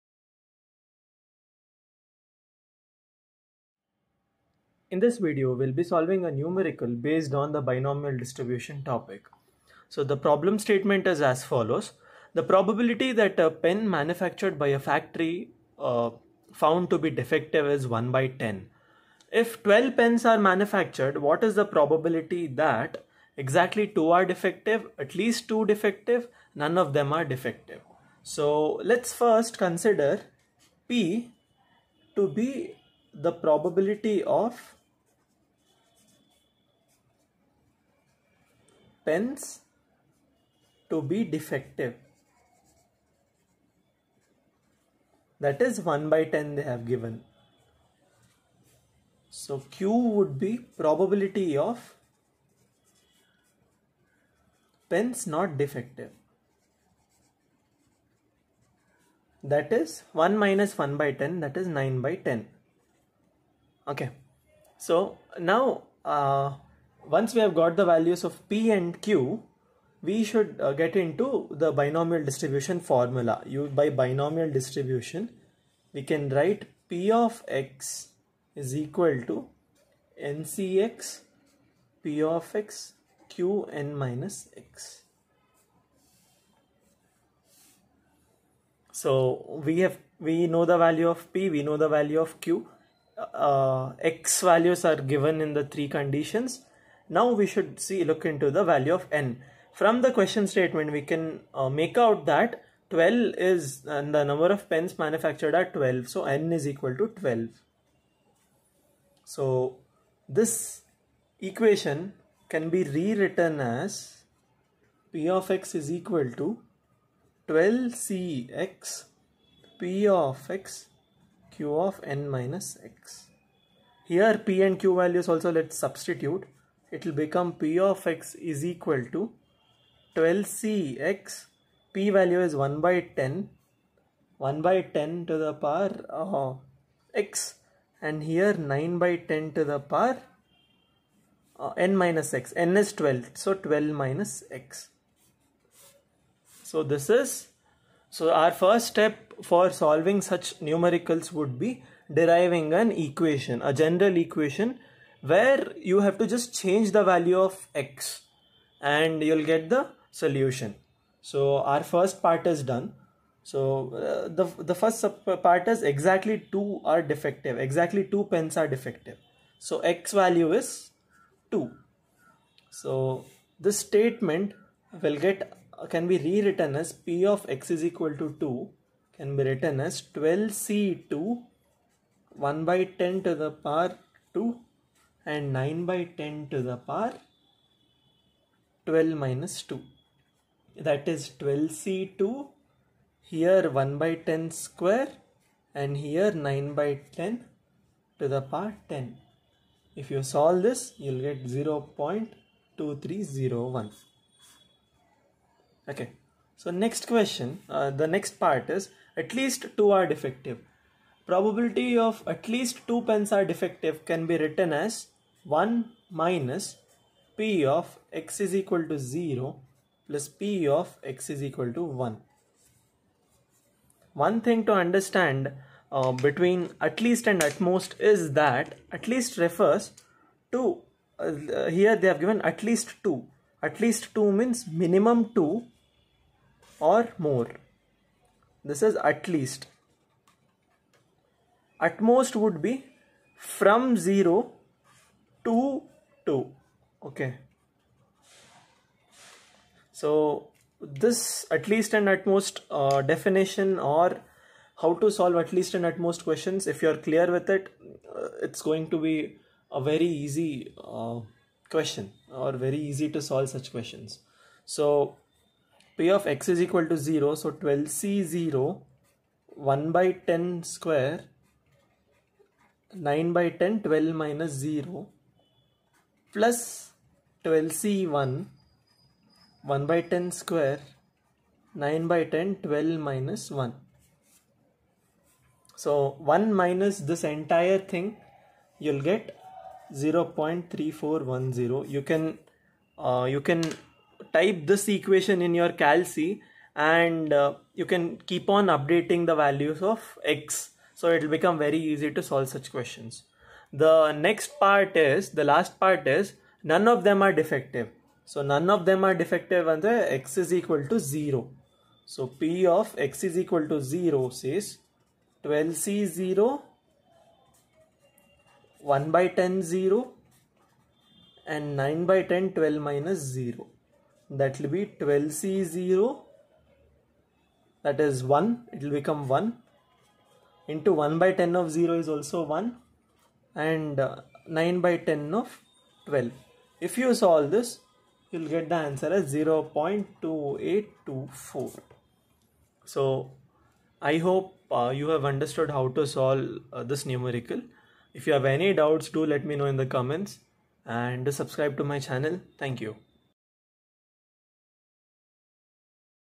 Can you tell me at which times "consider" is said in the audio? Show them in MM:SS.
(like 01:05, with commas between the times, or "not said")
00:29.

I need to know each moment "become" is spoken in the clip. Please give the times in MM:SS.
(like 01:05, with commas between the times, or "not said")
02:07, 05:01, 05:28.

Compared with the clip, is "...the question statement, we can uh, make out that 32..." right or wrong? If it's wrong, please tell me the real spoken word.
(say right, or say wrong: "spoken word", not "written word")
wrong: "12", not "32".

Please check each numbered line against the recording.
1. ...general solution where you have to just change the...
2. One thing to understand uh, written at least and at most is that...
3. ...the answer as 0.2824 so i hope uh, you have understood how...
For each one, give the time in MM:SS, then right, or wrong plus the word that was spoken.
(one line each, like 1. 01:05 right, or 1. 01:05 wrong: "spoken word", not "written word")
1. 02:33 wrong: "equation", not "solution"
2. 03:44 wrong: "between", not "written"
3. 05:38 right.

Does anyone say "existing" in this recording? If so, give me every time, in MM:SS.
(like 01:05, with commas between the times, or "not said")
not said.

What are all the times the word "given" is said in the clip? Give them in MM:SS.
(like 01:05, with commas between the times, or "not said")
00:46, 01:35, 03:52.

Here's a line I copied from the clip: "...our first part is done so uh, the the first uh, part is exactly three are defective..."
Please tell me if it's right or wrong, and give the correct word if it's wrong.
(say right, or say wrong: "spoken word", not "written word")
wrong: "two", not "three".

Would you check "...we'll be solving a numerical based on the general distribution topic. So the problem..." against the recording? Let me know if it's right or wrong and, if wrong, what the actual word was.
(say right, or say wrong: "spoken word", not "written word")
wrong: "binomial", not "general".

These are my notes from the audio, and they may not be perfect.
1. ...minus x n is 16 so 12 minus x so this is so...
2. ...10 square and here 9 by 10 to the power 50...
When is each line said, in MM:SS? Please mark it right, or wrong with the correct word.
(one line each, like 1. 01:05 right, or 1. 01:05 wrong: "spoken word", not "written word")
1. 02:21 wrong: "12", not "16"
2. 03:14 wrong: "10", not "50".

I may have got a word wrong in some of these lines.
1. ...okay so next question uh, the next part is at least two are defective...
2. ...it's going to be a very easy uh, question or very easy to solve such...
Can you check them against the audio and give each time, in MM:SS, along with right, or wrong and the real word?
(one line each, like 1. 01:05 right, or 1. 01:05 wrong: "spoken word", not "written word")
1. 03:25 right
2. 04:18 right.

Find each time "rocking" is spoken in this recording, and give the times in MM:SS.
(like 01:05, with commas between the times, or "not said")
not said.